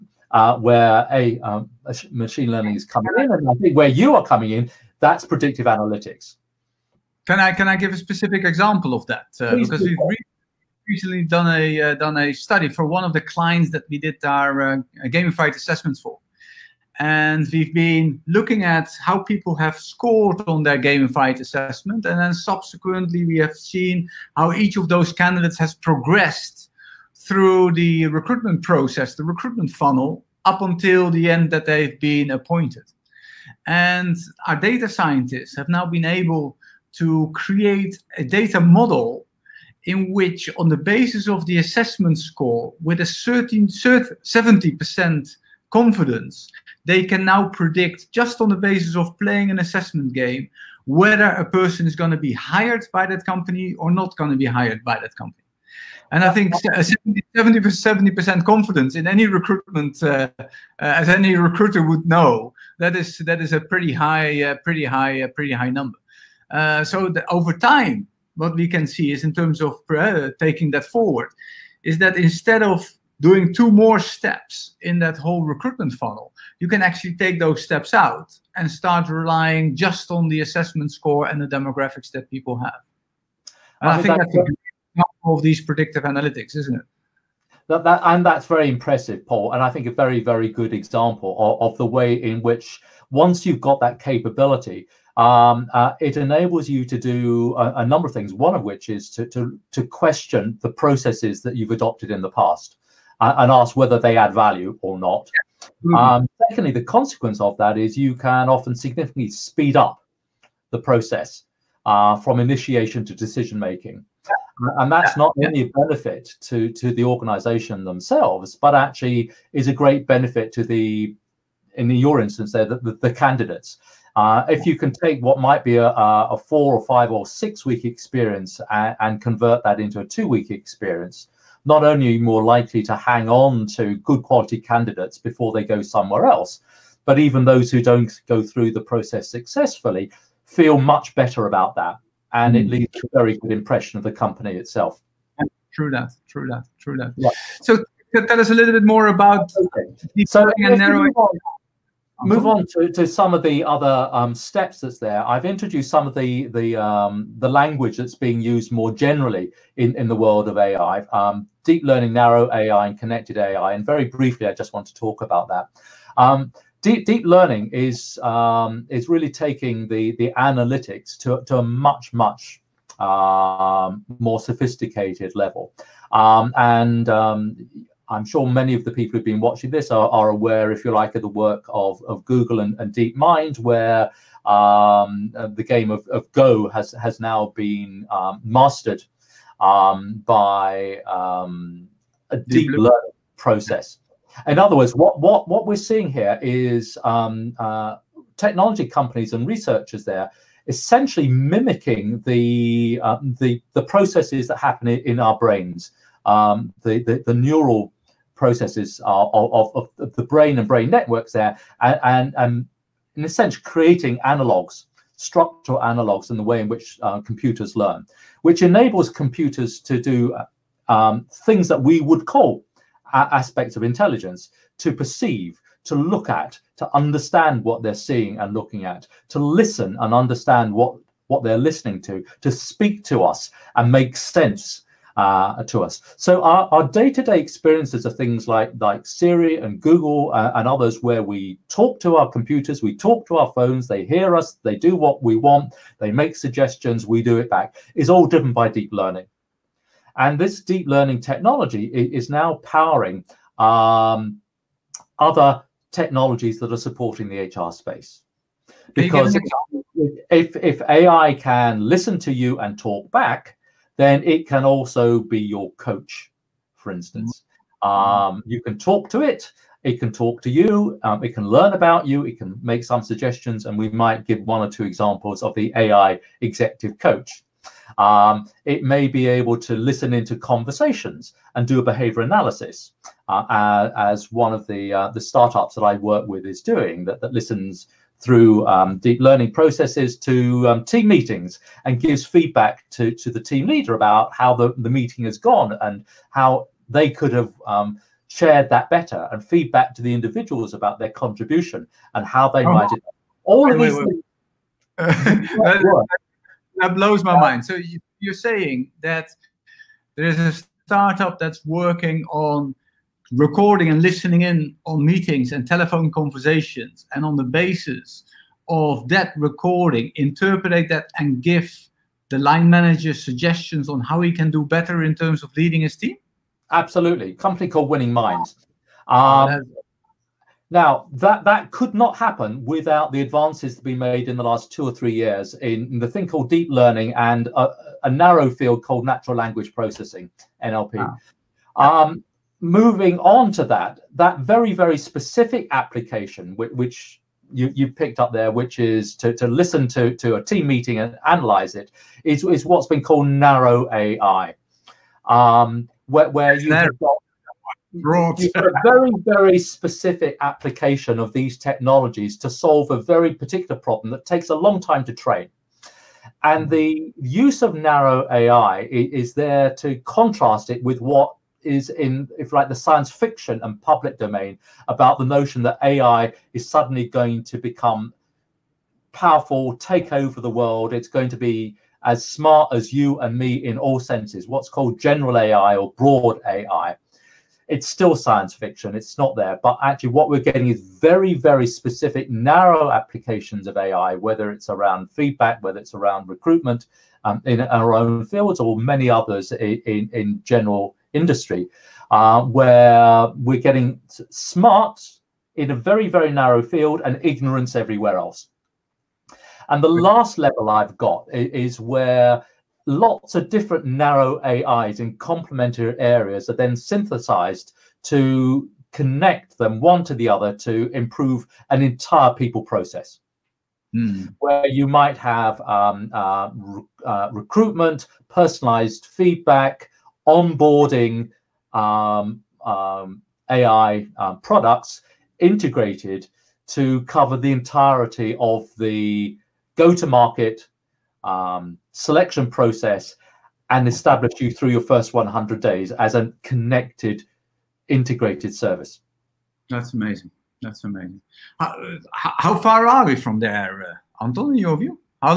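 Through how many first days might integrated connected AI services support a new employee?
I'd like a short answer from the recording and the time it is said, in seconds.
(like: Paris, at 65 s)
100, at 445 s.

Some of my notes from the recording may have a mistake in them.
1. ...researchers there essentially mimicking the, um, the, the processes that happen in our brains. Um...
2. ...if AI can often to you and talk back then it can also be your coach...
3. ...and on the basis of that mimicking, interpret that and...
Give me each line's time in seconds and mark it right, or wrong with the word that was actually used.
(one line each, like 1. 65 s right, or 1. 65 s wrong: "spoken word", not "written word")
1. 199 s right
2. 260 s wrong: "listen", not "often"
3. 317 s wrong: "recording", not "mimicking".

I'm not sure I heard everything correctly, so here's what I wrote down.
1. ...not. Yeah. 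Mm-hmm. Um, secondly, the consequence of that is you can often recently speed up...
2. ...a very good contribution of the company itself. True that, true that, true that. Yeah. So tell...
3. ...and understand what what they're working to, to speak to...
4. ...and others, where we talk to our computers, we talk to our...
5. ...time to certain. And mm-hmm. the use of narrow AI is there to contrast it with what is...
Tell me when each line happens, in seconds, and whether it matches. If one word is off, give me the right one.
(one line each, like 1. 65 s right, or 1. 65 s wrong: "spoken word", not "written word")
1. 104 s wrong: "significantly", not "recently"
2. 143 s wrong: "impression", not "contribution"
3. 229 s wrong: "listening", not "working"
4. 240 s right
5. 364 s wrong: "train", not "certain".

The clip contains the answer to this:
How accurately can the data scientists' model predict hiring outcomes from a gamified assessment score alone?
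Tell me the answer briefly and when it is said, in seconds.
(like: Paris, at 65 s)
70%, at 43 s.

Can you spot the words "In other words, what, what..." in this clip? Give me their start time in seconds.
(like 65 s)
194 s.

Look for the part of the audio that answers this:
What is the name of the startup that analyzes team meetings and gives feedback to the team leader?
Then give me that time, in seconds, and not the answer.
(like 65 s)
327 s.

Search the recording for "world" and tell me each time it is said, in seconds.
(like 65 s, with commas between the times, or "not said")
160 s, 380 s.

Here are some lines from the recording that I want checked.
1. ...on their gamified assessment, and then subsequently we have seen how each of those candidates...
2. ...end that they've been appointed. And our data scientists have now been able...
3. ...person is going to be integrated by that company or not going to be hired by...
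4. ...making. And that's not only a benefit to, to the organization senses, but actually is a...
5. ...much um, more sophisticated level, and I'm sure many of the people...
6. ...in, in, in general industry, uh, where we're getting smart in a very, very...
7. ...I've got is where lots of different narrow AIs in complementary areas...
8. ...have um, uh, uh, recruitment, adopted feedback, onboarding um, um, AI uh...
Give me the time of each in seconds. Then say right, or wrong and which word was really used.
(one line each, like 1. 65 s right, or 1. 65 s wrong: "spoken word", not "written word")
1. 20 s right
2. 31 s right
3. 51 s wrong: "hired", not "integrated"
4. 113 s wrong: "themselves", not "senses"
5. 172 s right
6. 399 s right
7. 410 s right
8. 425 s wrong: "personalized", not "adopted".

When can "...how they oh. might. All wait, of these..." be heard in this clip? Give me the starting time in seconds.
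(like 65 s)
302 s.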